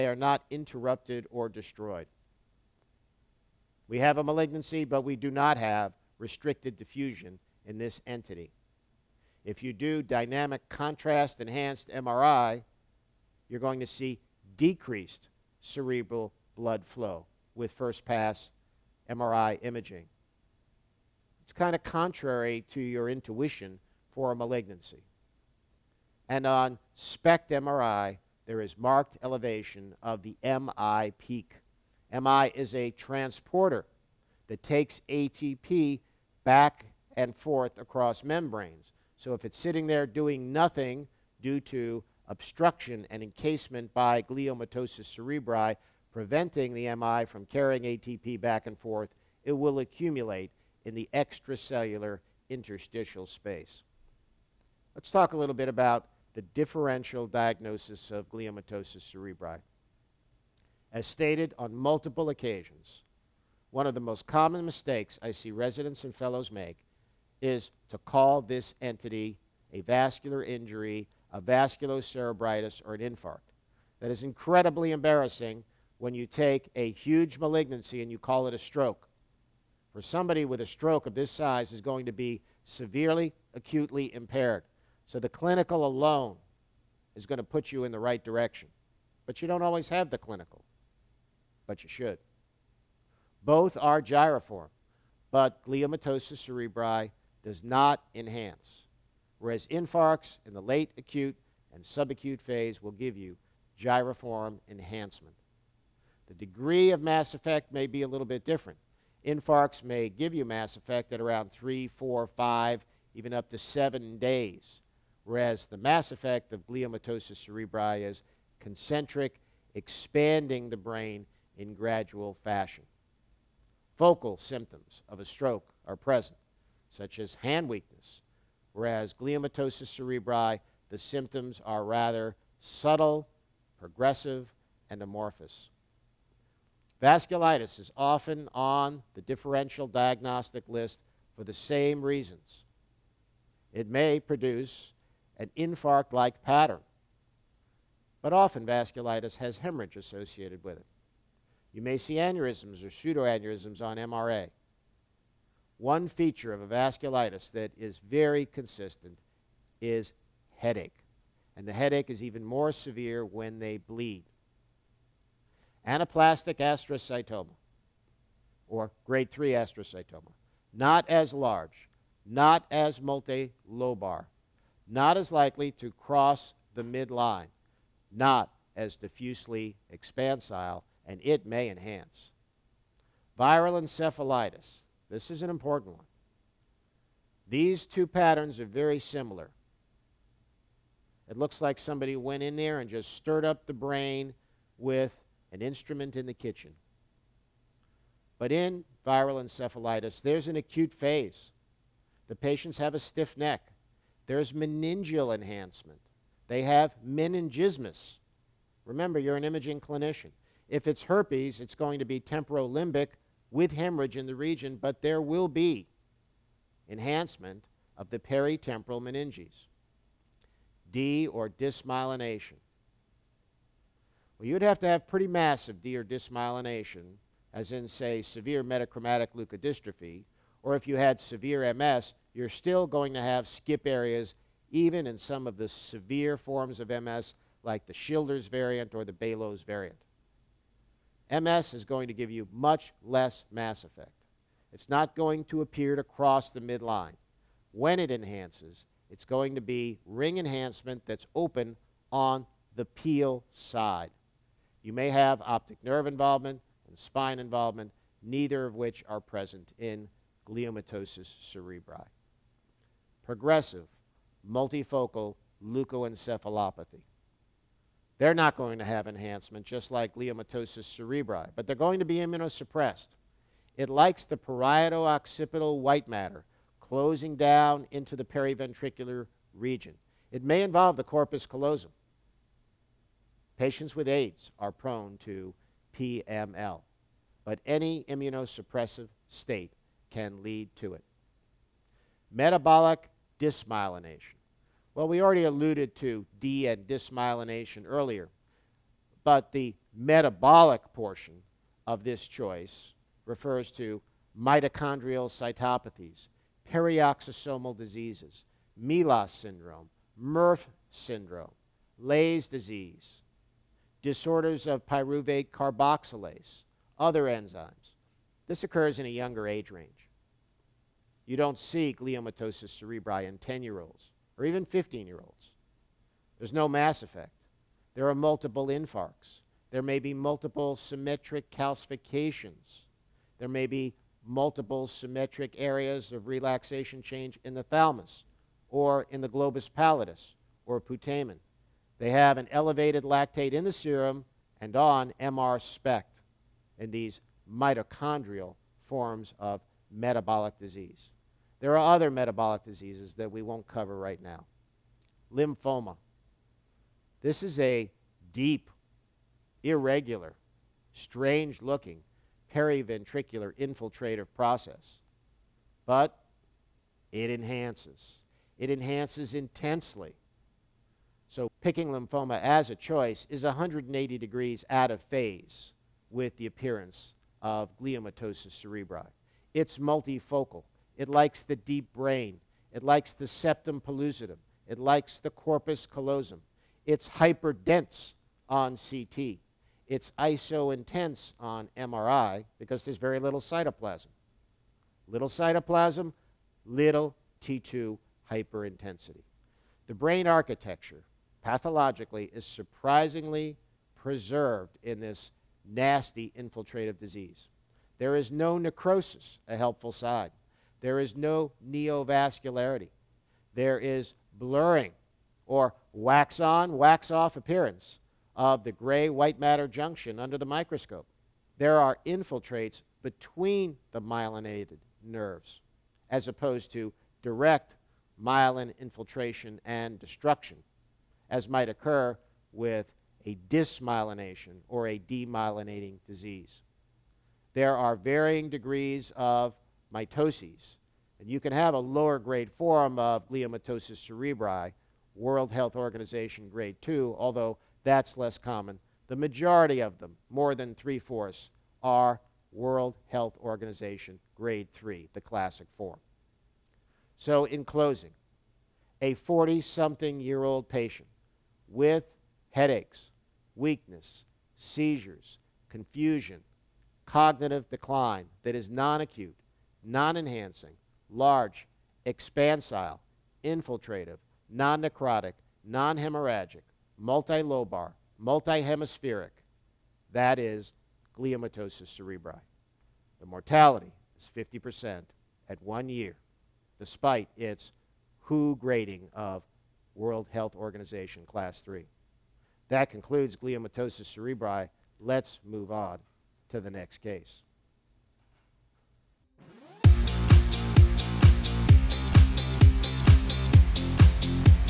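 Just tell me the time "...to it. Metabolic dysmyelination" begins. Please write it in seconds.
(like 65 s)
290 s.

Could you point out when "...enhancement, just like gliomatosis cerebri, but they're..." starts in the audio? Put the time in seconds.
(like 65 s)
269 s.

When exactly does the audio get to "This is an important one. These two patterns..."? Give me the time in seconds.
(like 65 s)
185 s.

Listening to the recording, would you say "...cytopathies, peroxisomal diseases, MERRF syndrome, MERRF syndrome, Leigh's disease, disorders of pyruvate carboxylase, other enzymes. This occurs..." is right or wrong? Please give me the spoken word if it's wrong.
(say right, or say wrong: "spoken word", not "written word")
wrong: "MELAS", not "MERRF".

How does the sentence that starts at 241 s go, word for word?
MS is going to give you much less mass effect.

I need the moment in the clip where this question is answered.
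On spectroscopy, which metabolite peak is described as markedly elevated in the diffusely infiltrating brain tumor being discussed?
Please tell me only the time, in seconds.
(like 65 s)
30 s.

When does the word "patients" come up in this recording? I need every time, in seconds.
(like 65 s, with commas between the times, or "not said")
202 s, 283 s, 460 s.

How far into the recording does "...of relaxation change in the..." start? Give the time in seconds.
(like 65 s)
336 s.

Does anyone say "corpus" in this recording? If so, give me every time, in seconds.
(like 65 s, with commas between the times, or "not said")
281 s, 385 s.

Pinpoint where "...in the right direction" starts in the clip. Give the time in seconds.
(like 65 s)
87 s.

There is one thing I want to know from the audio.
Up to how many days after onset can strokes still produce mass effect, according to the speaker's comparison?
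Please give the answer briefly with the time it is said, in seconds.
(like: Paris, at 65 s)
7, at 113 s.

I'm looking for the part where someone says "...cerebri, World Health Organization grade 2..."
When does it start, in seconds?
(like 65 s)
444 s.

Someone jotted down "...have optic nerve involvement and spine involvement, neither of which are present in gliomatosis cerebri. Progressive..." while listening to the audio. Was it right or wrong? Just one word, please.
right.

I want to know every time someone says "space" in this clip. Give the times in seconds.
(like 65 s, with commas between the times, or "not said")
53 s.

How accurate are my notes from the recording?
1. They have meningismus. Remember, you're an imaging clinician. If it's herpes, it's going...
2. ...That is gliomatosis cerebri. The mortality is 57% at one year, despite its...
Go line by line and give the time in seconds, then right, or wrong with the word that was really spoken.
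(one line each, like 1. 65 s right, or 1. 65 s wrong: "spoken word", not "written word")
1. 206 s right
2. 480 s wrong: "50", not "57".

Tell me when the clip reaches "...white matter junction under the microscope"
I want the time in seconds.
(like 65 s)
419 s.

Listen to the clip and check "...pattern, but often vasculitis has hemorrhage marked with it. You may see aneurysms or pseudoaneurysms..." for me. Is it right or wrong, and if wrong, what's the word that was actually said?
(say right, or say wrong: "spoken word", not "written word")
wrong: "associated", not "marked".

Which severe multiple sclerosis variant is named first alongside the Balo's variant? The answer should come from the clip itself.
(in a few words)
Schilder's variant.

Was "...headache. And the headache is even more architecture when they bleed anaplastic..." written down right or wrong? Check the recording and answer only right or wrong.
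wrong.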